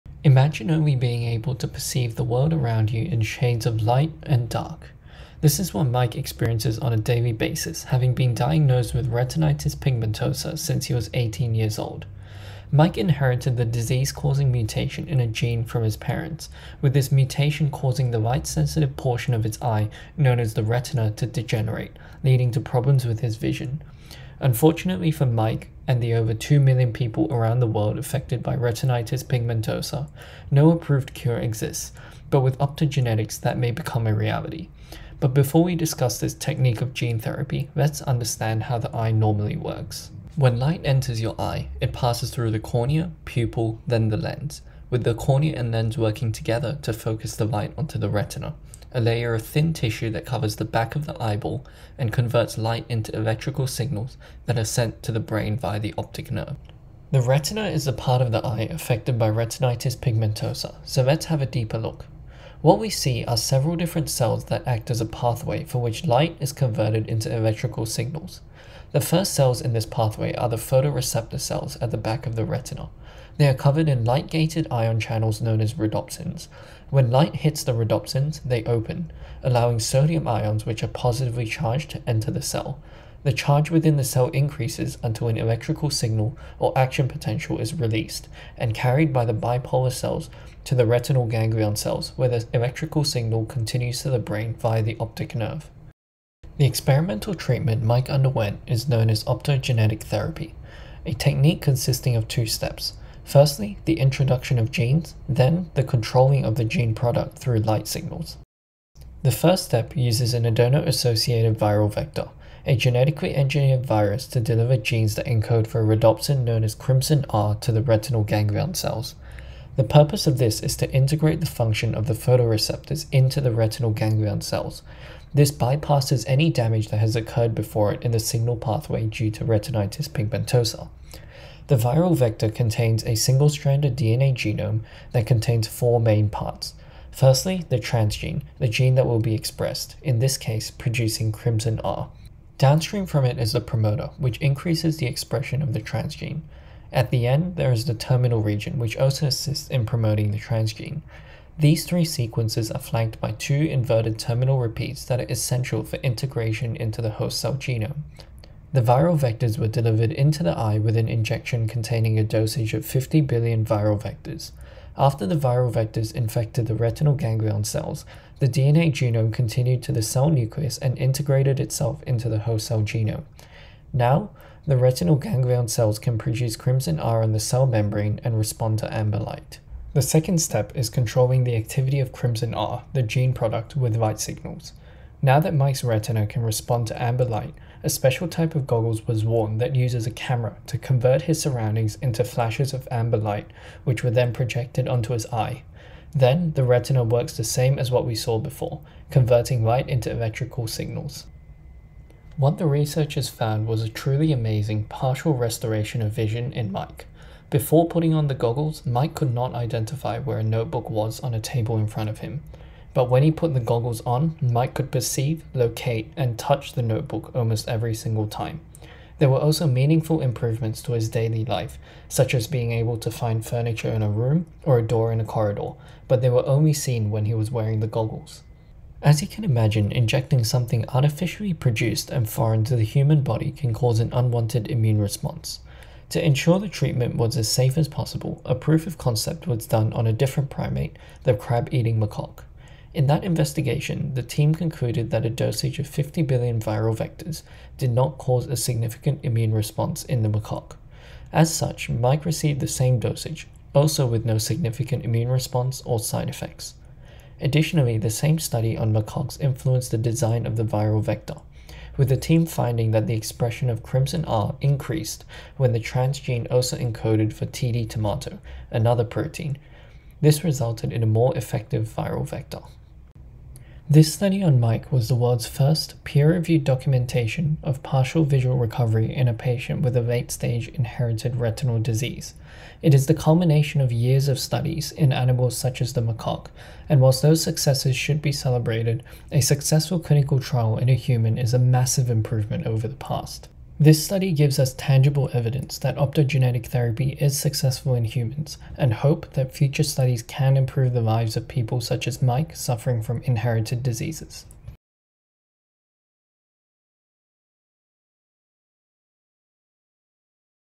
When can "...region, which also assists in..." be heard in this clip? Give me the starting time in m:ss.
2:28.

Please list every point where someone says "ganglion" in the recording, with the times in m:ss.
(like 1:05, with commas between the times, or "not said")
1:31, 1:58, 2:03, 2:47, 2:55.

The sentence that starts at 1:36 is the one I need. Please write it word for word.
The experimental treatment Mike underwent is known as optogenetic therapy, a technique consisting of two steps.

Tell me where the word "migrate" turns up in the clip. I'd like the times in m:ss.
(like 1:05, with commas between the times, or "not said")
not said.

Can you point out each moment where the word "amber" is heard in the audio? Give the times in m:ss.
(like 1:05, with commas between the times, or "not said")
2:58, 3:07, 3:12.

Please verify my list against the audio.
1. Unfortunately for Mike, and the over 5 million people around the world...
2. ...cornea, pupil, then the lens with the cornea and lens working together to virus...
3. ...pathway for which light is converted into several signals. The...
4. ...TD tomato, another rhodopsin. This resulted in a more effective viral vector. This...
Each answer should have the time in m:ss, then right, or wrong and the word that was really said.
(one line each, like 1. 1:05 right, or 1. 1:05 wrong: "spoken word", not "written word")
1. 0:24 wrong: "2", not "5"
2. 0:42 wrong: "focus", not "virus"
3. 1:05 wrong: "electrical", not "several"
4. 4:27 wrong: "protein", not "rhodopsin".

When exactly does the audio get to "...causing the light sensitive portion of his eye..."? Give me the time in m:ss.
0:17.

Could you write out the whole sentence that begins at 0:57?
The retina is the part of the eye affected by retinitis pigmentosa, so let's have a deeper look.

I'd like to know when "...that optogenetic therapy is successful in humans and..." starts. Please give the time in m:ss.
4:55.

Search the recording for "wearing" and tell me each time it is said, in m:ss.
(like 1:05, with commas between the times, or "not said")
3:47.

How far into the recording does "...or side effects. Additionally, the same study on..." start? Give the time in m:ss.
4:15.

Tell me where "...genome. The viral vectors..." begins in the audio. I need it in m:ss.
2:37.